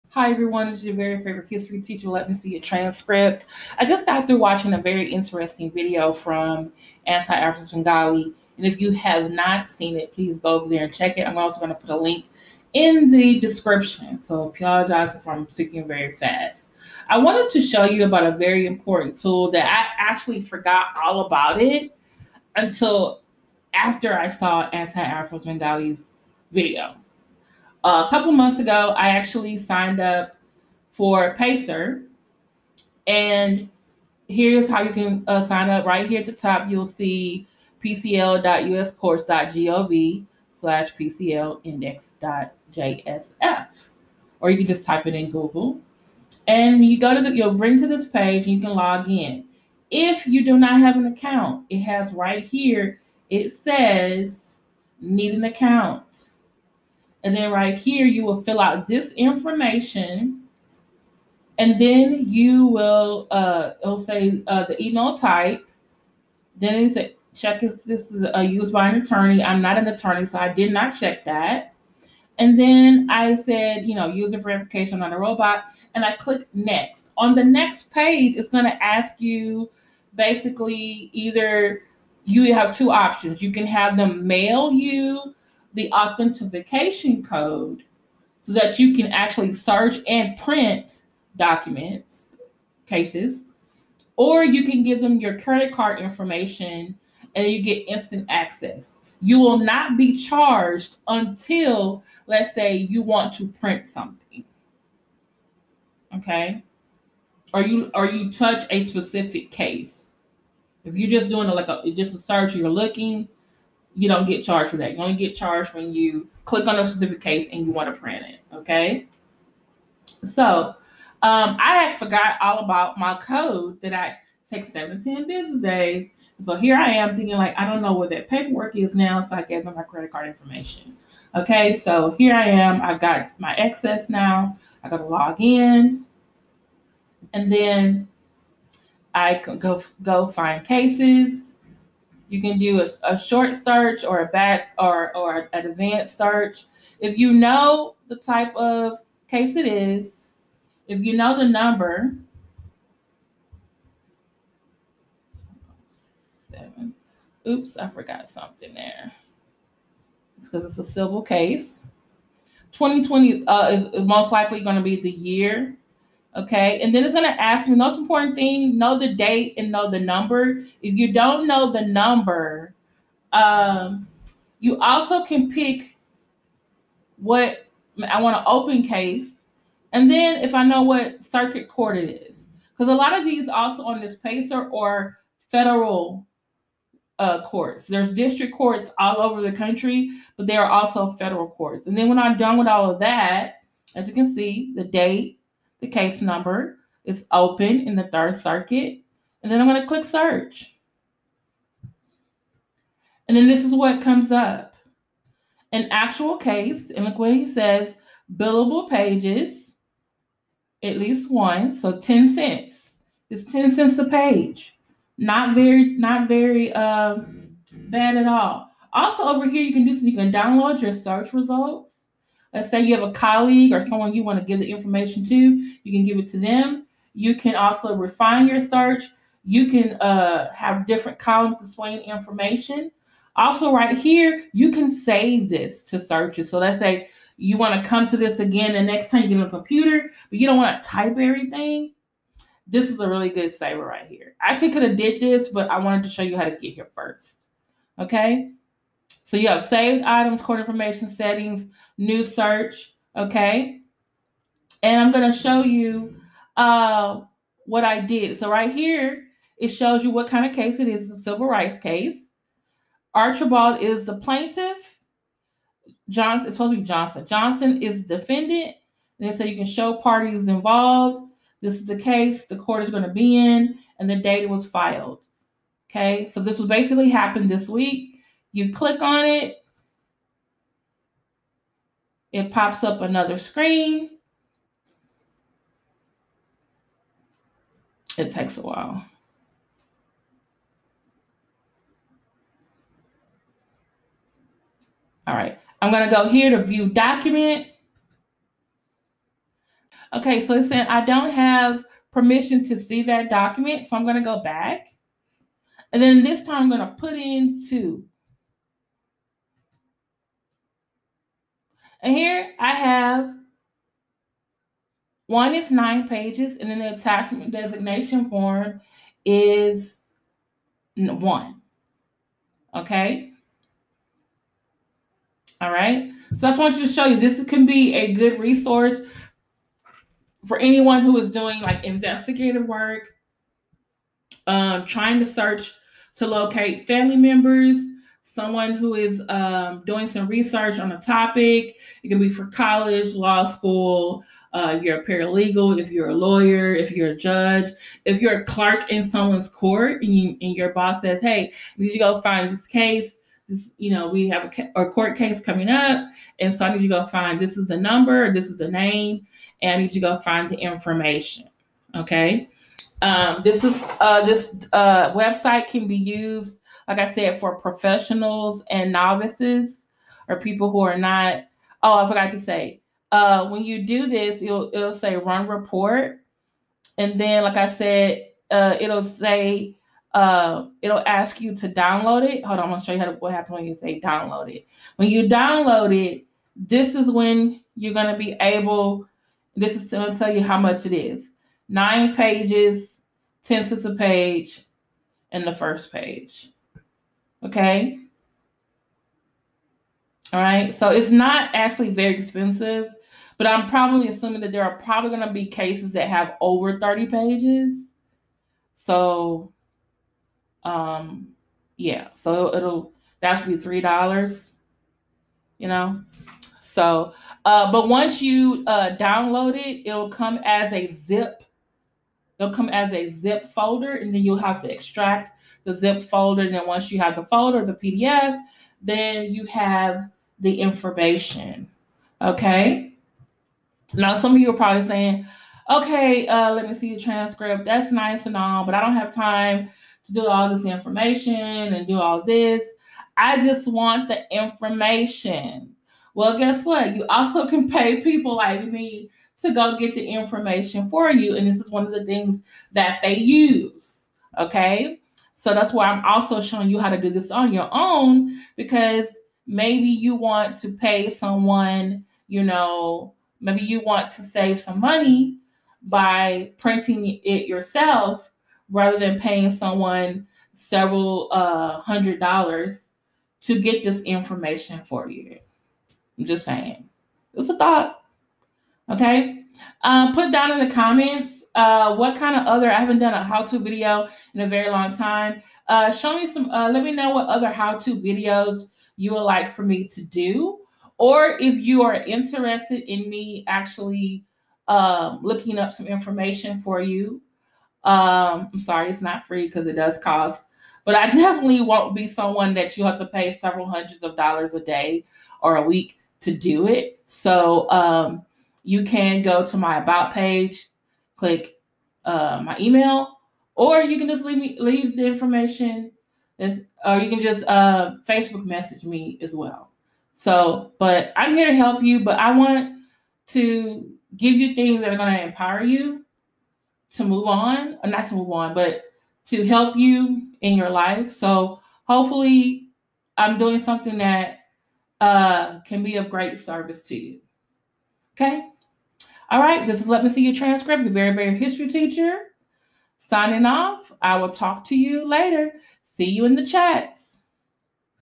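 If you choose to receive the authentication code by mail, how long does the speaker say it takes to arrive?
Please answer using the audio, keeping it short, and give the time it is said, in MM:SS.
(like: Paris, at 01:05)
7-10 business days, at 02:04.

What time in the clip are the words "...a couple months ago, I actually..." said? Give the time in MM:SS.
00:27.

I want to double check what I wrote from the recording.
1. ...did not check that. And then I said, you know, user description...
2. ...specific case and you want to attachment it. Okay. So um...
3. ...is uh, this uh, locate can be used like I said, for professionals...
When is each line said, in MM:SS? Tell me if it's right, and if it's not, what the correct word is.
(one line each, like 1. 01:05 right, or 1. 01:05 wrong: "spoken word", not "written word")
1. 01:10 wrong: "verification", not "description"
2. 01:56 wrong: "print", not "attachment"
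3. 06:03 wrong: "website", not "locate".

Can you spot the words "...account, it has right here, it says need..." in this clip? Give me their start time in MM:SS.
00:51.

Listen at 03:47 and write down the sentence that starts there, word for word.
You can also refine your search.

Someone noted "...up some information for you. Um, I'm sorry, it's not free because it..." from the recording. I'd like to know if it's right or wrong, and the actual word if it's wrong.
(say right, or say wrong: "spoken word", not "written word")
right.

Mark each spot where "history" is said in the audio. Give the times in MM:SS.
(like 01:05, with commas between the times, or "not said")
00:01, 09:01.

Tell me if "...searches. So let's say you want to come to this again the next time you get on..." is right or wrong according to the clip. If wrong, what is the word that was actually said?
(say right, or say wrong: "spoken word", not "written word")
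right.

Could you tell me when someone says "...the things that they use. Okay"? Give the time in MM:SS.
07:31.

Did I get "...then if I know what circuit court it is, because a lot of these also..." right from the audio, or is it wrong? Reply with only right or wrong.
right.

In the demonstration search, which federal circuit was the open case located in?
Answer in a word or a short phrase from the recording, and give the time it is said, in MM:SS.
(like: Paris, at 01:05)
Third Circuit, at 03:18.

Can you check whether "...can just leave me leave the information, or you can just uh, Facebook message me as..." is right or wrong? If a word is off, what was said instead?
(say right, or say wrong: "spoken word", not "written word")
right.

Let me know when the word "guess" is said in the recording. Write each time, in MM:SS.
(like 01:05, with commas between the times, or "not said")
07:26.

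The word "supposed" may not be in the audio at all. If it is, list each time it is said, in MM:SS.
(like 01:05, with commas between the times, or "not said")
04:26.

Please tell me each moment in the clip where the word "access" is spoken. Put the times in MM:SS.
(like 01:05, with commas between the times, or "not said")
01:38, 02:13.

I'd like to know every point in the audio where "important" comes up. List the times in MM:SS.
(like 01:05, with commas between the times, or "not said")
00:18, 02:47.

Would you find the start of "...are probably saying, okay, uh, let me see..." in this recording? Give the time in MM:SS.
07:14.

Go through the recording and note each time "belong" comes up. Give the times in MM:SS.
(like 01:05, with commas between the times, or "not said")
not said.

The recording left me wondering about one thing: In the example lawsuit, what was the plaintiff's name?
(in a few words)
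Archibald.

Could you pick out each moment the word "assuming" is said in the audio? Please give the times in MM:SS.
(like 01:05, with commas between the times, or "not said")
06:44.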